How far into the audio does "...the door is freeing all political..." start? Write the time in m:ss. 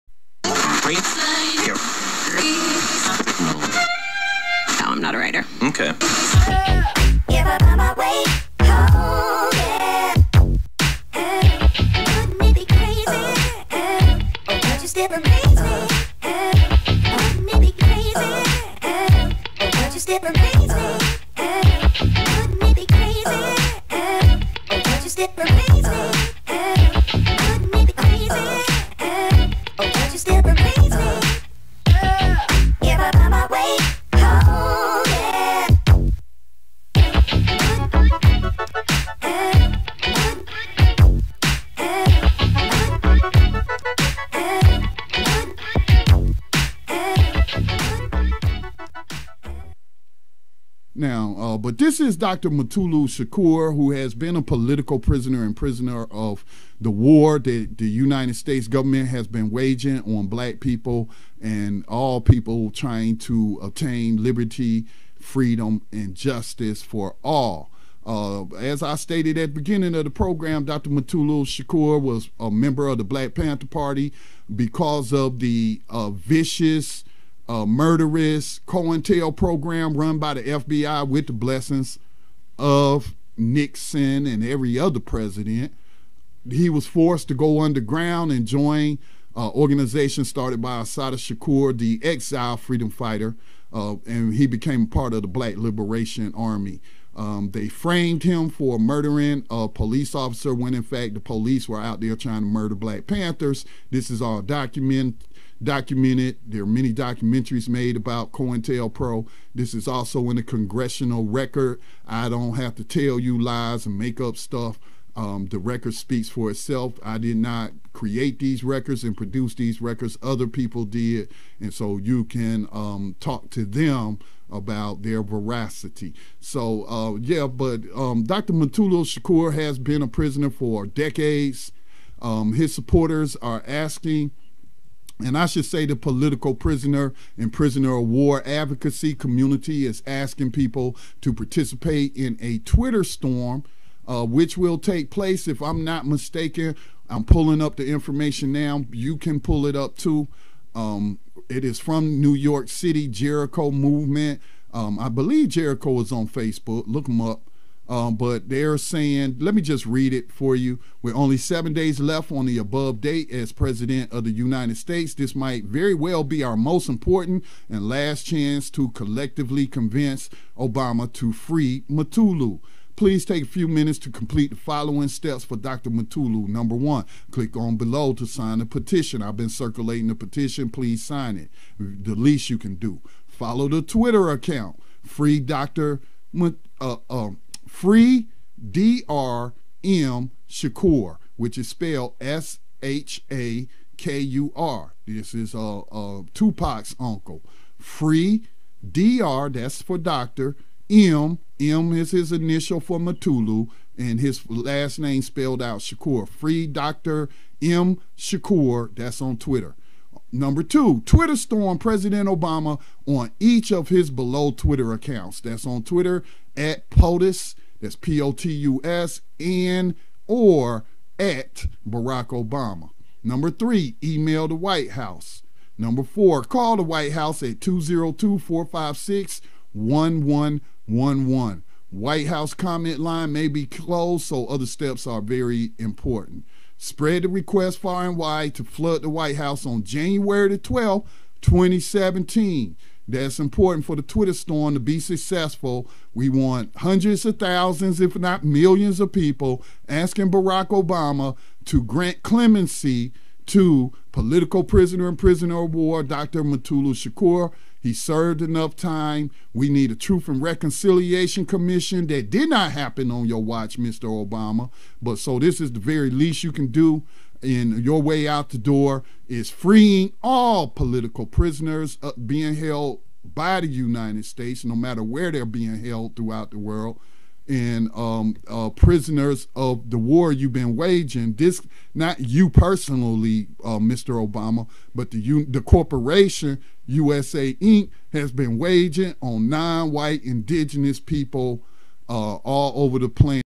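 4:28.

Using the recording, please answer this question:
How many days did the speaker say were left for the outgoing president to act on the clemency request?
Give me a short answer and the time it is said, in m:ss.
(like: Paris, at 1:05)
7, at 2:41.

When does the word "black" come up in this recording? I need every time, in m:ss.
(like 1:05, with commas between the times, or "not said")
1:00, 1:13, 1:35, 1:42.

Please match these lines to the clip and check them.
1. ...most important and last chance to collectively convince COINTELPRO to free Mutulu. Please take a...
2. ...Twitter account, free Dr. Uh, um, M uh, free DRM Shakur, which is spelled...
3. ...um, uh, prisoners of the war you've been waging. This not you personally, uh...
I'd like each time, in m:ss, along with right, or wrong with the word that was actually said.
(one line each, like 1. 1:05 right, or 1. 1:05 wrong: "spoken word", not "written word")
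1. 2:46 wrong: "Obama", not "COINTELPRO"
2. 3:03 right
3. 4:37 right.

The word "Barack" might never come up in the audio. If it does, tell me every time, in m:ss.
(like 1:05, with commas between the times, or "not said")
3:41, 4:10.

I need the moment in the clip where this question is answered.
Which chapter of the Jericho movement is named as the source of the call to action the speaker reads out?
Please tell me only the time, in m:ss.
2:32.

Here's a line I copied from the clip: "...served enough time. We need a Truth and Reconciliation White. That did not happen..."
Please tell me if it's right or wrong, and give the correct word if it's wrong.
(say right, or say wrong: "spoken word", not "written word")
wrong: "Commission", not "White".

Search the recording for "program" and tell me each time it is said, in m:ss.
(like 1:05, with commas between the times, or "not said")
1:10, 1:19.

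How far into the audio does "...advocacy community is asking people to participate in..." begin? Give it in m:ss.
2:18.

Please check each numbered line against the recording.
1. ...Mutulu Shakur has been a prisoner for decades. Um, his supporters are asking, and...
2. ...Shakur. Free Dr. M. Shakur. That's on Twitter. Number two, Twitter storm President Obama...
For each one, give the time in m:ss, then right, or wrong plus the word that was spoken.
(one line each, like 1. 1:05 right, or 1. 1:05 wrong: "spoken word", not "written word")
1. 2:08 right
2. 3:25 right.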